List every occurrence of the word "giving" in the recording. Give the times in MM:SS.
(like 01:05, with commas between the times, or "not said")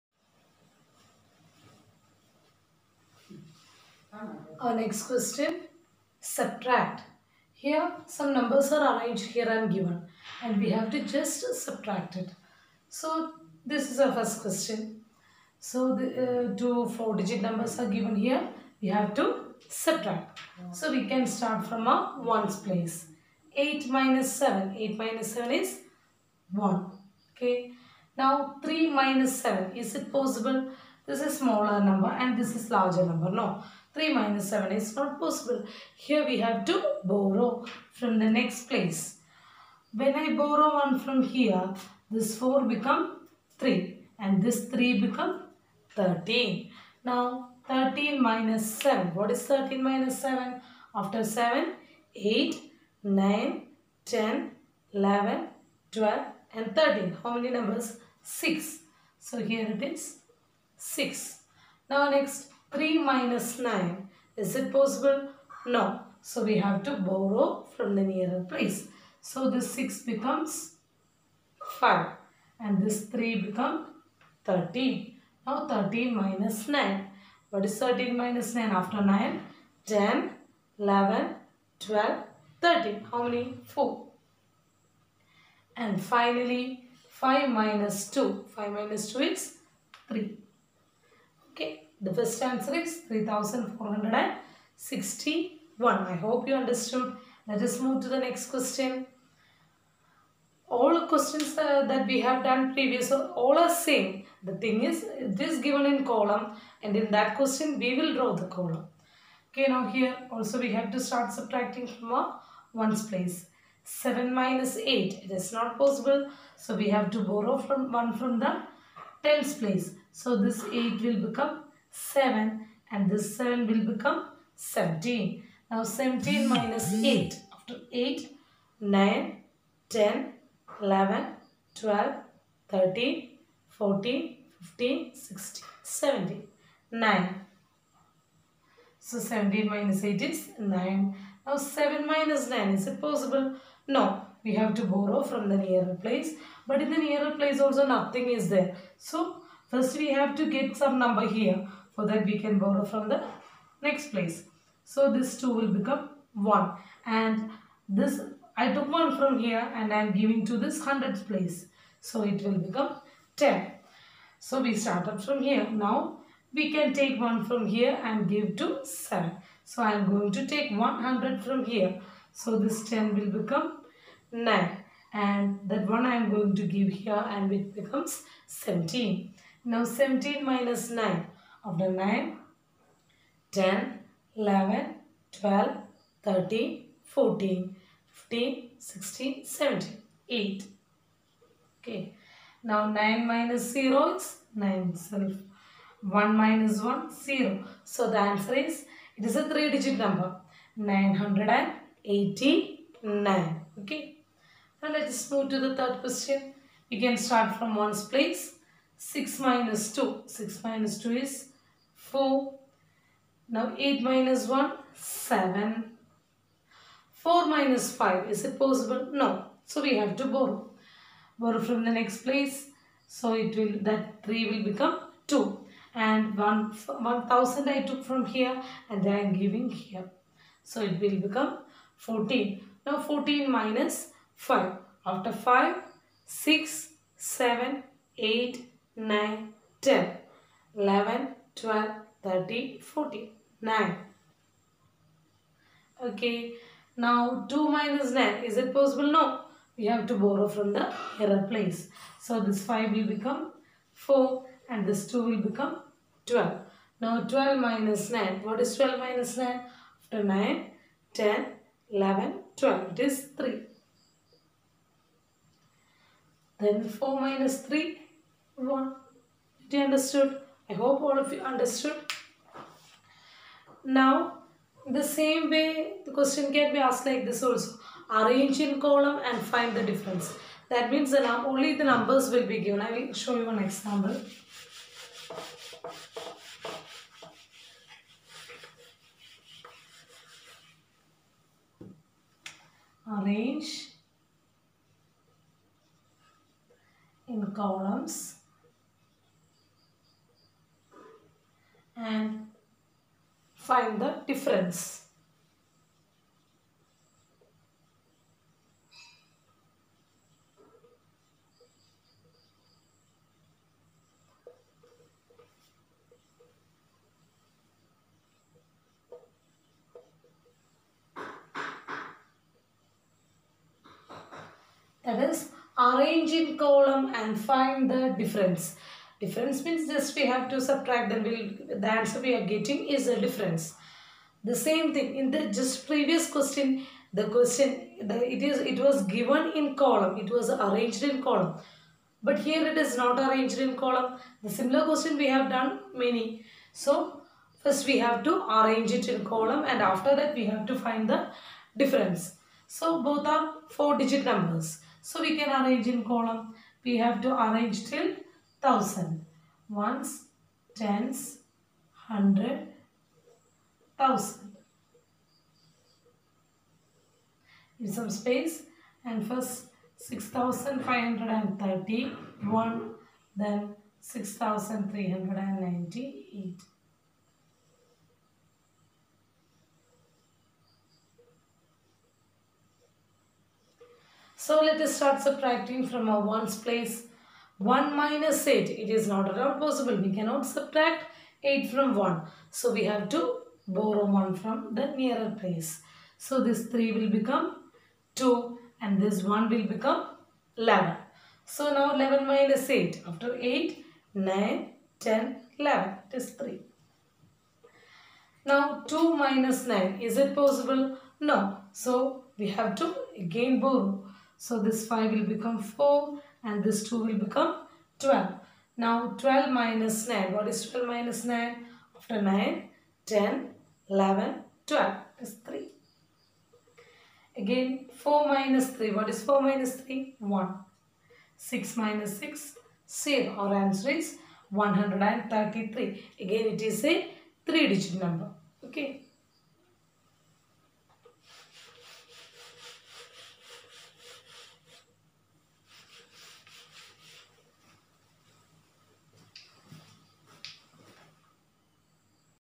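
02:40, 03:49.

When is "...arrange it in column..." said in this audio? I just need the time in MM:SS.
05:48.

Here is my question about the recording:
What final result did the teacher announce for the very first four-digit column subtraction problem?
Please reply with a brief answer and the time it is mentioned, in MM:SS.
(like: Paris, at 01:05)
3461, at 01:33.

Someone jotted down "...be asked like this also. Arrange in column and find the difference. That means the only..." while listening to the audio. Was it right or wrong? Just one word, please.
right.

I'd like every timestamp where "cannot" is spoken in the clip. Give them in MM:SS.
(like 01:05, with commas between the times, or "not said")
06:30.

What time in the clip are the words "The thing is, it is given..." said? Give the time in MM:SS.
01:44.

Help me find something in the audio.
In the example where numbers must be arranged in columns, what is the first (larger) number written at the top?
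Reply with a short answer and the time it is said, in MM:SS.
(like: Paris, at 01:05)
6531, at 06:09.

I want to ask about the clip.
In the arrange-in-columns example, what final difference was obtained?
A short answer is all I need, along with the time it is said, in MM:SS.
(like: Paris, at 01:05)
133, at 07:14.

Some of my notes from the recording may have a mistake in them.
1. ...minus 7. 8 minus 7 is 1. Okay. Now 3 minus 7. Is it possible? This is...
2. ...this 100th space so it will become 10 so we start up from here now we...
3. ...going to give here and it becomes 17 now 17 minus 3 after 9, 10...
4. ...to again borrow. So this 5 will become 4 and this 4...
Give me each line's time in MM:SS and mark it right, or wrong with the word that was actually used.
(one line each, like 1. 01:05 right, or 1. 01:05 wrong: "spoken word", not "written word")
1. 00:23 right
2. 02:40 wrong: "place", not "space"
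3. 02:56 wrong: "9", not "3"
4. 06:52 wrong: "2", not "4".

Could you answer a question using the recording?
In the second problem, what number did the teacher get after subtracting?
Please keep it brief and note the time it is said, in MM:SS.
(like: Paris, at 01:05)
989, at 03:20.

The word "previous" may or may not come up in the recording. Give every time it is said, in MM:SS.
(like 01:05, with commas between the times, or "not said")
01:42, 05:35.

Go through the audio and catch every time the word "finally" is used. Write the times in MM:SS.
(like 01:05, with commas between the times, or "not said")
01:26.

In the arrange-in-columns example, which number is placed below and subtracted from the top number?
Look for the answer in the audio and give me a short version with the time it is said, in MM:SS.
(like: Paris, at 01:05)
6398, at 06:14.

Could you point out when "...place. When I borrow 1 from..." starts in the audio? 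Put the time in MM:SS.
00:38.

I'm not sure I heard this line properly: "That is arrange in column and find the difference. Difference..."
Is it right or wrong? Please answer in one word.
right.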